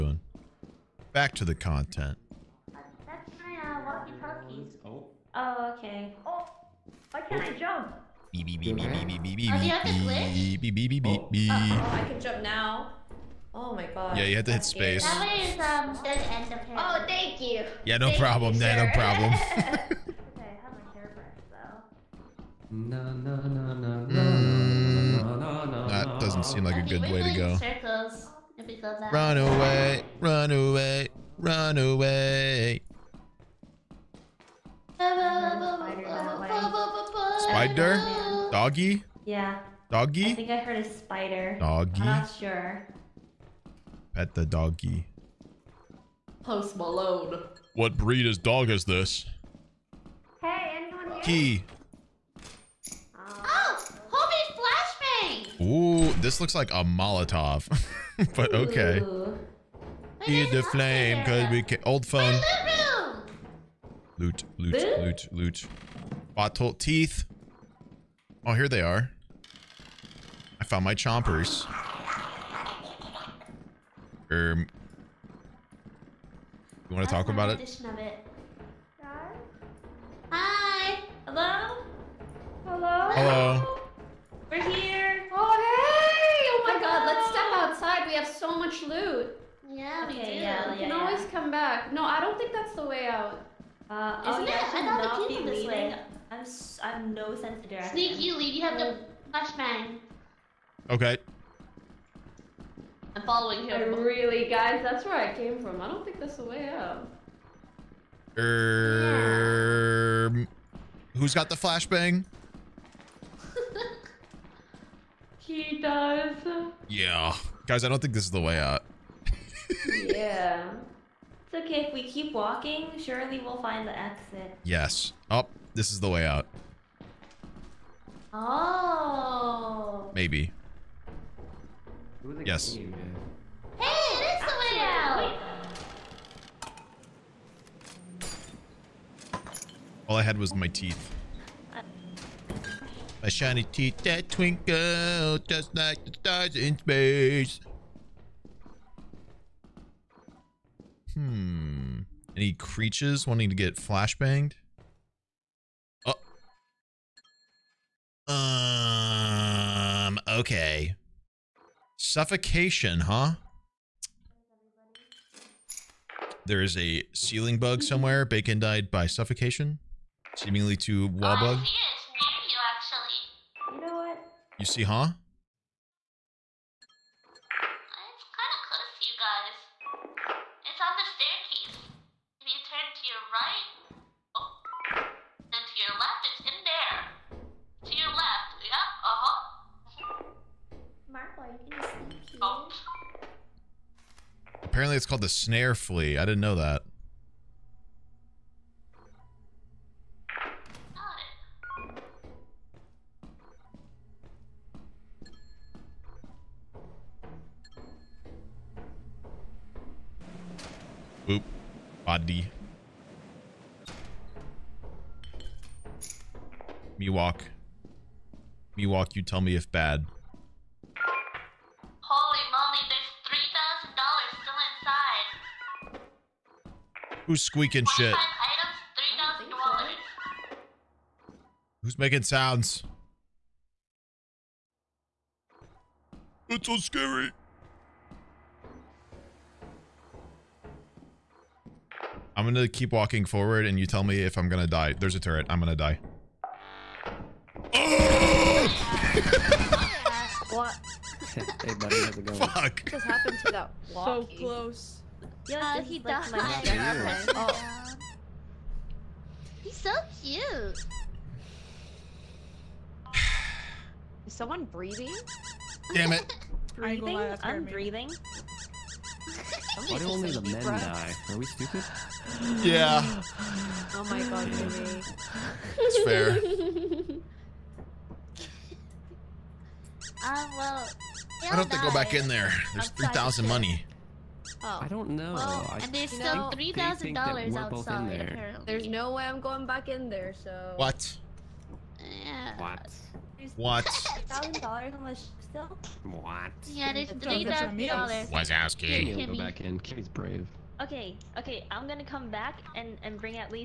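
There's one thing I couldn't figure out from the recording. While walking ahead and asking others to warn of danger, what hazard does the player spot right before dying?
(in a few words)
A turret.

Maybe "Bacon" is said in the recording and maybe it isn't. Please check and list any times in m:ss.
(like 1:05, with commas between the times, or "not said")
2:48.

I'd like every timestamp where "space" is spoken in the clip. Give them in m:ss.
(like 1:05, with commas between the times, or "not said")
0:14, 2:26.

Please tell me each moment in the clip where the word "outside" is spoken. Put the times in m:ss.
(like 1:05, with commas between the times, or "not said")
1:27, 4:47.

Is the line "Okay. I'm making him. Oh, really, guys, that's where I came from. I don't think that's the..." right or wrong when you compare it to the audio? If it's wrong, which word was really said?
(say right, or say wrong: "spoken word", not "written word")
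wrong: "following", not "making".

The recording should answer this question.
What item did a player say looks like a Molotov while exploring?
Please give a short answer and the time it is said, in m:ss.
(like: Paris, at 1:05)
old phone, at 1:01.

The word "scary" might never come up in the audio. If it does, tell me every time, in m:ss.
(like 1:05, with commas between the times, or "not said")
3:56.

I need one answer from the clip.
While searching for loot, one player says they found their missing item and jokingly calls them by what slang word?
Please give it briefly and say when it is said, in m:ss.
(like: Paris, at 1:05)
chompers, at 1:10.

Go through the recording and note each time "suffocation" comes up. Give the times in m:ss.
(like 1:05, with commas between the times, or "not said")
2:41, 2:49.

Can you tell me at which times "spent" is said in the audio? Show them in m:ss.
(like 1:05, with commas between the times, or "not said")
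not said.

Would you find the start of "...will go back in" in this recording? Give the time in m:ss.
4:59.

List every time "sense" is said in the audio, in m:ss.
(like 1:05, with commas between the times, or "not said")
1:37.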